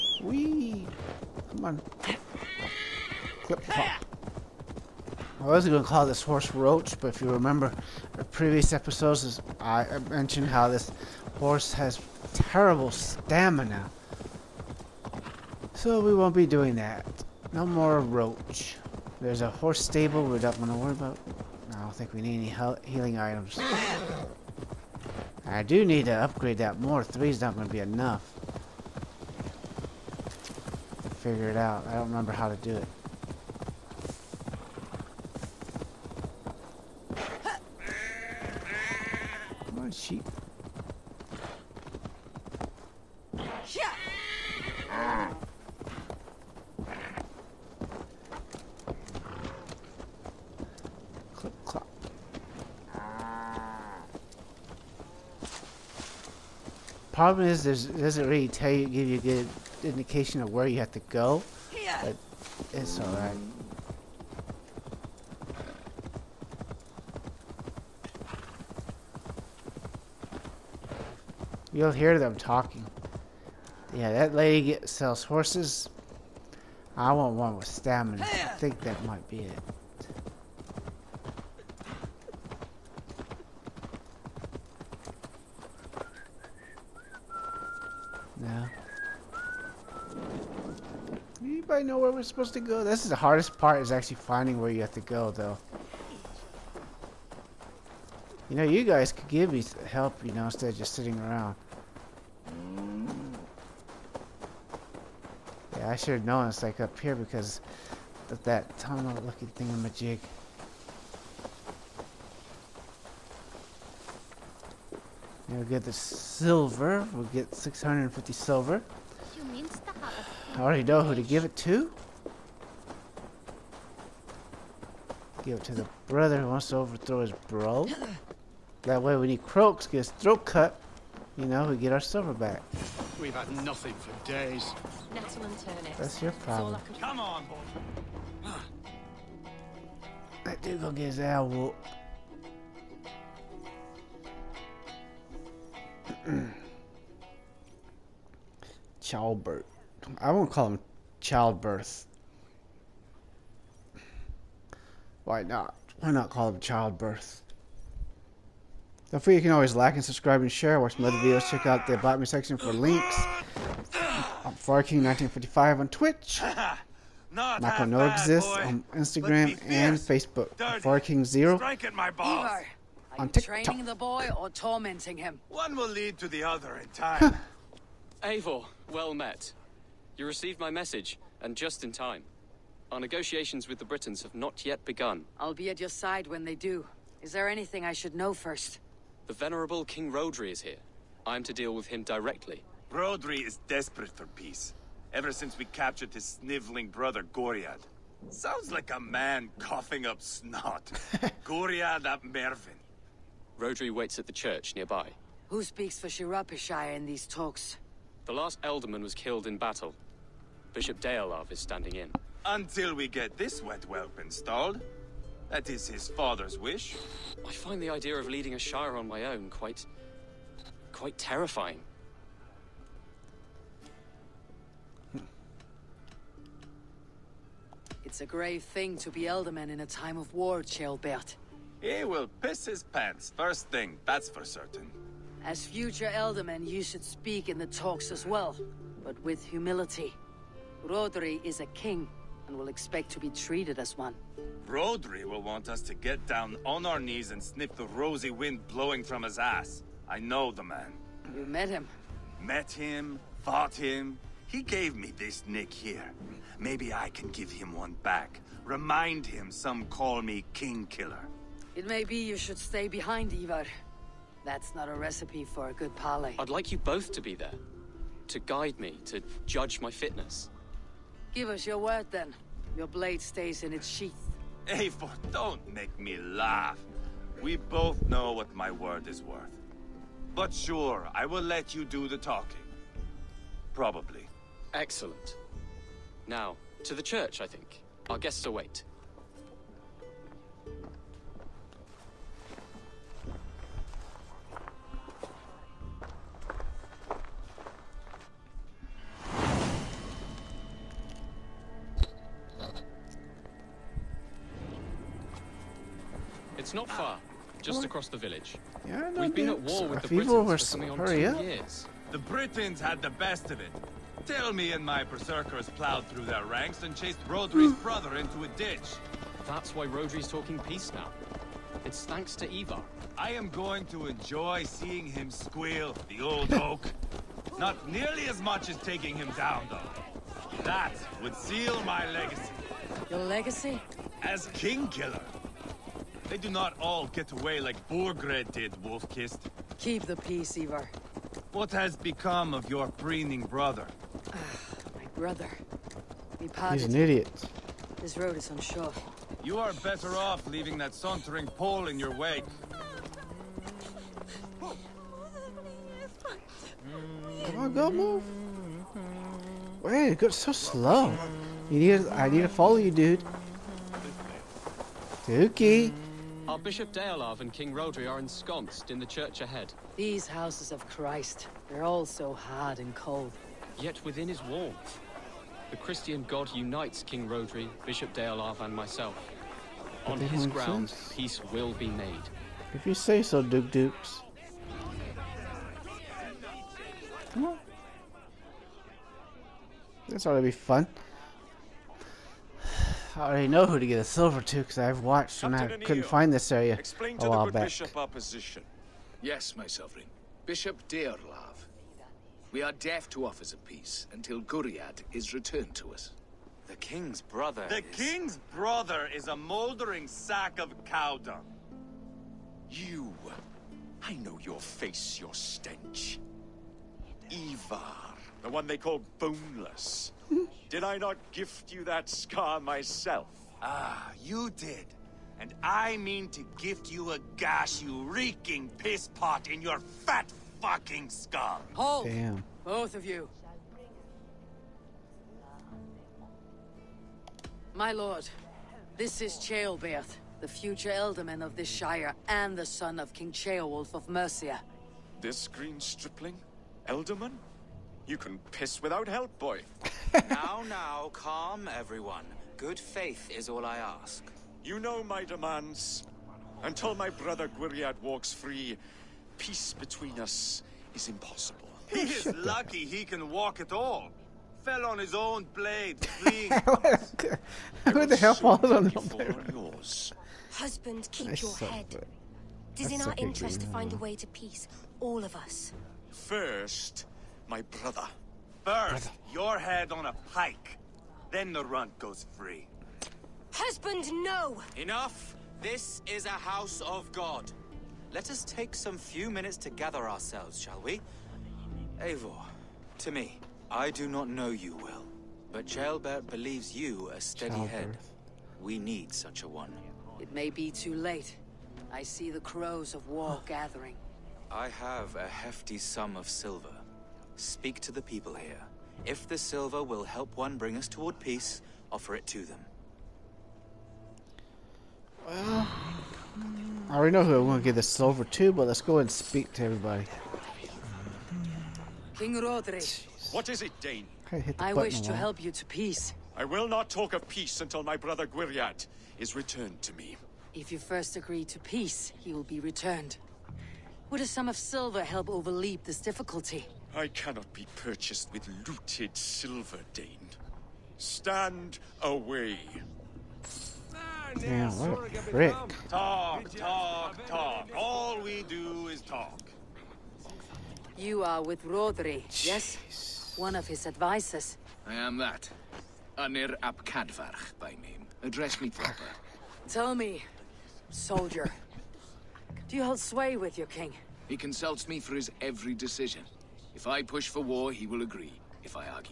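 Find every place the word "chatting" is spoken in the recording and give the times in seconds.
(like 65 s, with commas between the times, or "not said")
not said.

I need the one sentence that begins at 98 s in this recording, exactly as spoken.
You know, you guys could give me help, you know, instead of just sitting around.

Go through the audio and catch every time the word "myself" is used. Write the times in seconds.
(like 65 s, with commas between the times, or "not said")
378 s, 422 s.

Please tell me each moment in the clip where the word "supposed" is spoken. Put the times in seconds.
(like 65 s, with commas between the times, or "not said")
92 s.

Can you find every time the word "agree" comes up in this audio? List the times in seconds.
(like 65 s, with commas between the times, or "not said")
531 s, 568 s.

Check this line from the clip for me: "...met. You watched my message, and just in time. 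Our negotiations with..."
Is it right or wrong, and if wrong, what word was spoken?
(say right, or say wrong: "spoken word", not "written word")
wrong: "received", not "watched".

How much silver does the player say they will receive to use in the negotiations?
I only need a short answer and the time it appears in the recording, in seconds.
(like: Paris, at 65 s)
650 silver, at 117 s.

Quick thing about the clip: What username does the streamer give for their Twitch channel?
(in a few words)
FarKing1955.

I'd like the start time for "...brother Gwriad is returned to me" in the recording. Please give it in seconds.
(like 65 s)
527 s.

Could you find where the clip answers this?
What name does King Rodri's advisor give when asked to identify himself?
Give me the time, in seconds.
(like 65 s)
556 s.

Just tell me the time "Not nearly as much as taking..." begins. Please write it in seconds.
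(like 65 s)
327 s.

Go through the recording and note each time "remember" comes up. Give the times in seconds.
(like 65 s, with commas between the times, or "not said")
7 s, 32 s.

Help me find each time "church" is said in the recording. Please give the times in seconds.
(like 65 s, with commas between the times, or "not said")
204 s, 287 s, 369 s.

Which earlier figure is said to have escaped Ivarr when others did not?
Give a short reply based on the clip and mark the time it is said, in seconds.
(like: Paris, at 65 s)
Burgred, at 337 s.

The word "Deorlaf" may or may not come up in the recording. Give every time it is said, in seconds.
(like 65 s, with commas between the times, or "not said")
211 s, 366 s, 378 s, 400 s.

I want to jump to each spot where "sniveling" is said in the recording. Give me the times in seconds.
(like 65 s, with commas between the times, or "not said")
196 s.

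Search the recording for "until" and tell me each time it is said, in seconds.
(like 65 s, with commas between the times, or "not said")
212 s, 404 s, 456 s, 527 s.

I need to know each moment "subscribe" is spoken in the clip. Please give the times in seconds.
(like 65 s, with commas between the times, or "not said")
160 s.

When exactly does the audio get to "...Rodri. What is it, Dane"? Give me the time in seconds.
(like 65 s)
522 s.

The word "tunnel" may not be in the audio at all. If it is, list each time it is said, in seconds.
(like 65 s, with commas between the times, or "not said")
108 s.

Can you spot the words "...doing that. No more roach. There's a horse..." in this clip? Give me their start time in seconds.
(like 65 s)
16 s.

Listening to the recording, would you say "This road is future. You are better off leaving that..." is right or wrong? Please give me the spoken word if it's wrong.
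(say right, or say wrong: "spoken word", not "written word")
wrong: "unsure", not "future".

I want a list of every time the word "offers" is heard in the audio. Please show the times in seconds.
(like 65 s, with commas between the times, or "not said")
403 s, 511 s.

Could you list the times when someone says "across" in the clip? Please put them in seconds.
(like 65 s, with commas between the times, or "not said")
307 s.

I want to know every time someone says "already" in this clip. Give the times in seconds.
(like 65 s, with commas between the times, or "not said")
120 s, 393 s, 516 s.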